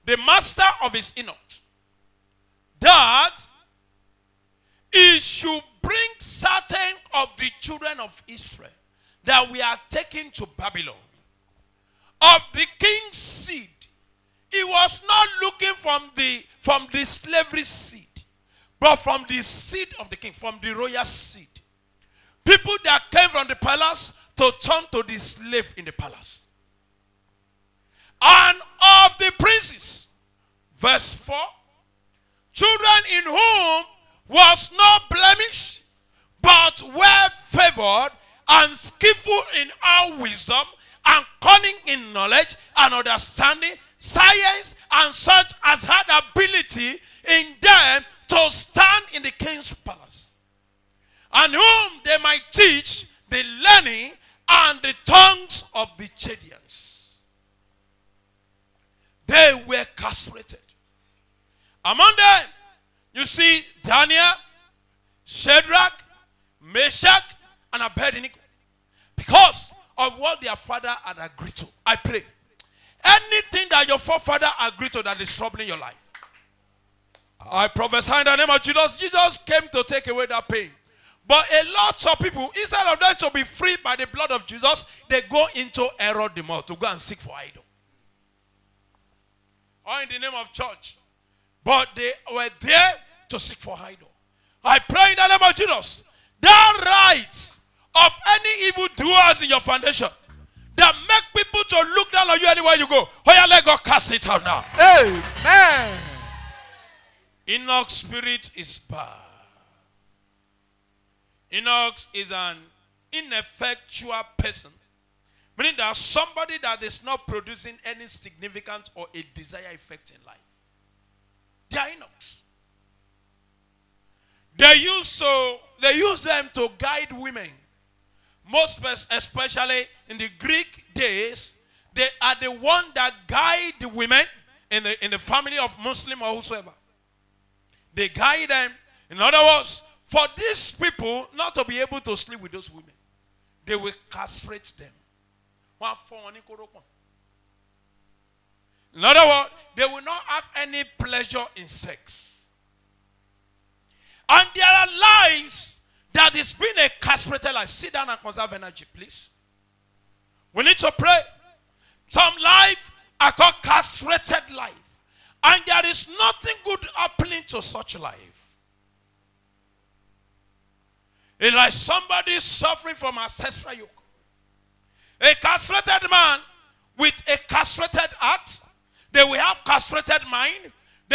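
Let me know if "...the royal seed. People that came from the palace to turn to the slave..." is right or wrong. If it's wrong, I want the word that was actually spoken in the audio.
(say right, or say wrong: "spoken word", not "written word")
right.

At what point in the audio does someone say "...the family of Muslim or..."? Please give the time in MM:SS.
02:15.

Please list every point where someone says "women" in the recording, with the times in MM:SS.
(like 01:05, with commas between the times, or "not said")
02:07, 02:13, 02:22.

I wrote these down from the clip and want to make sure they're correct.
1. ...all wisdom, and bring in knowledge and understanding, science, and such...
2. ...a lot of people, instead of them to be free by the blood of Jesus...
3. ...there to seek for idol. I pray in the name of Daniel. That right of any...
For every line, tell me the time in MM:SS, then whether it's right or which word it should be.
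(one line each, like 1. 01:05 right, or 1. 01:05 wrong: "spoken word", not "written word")
1. 00:39 wrong: "cunning", not "bring"
2. 01:21 right
3. 01:32 wrong: "Jesus", not "Daniel".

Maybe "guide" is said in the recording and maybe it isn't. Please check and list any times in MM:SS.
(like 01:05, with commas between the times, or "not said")
02:06, 02:13, 02:18.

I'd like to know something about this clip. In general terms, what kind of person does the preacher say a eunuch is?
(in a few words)
An ineffectual person.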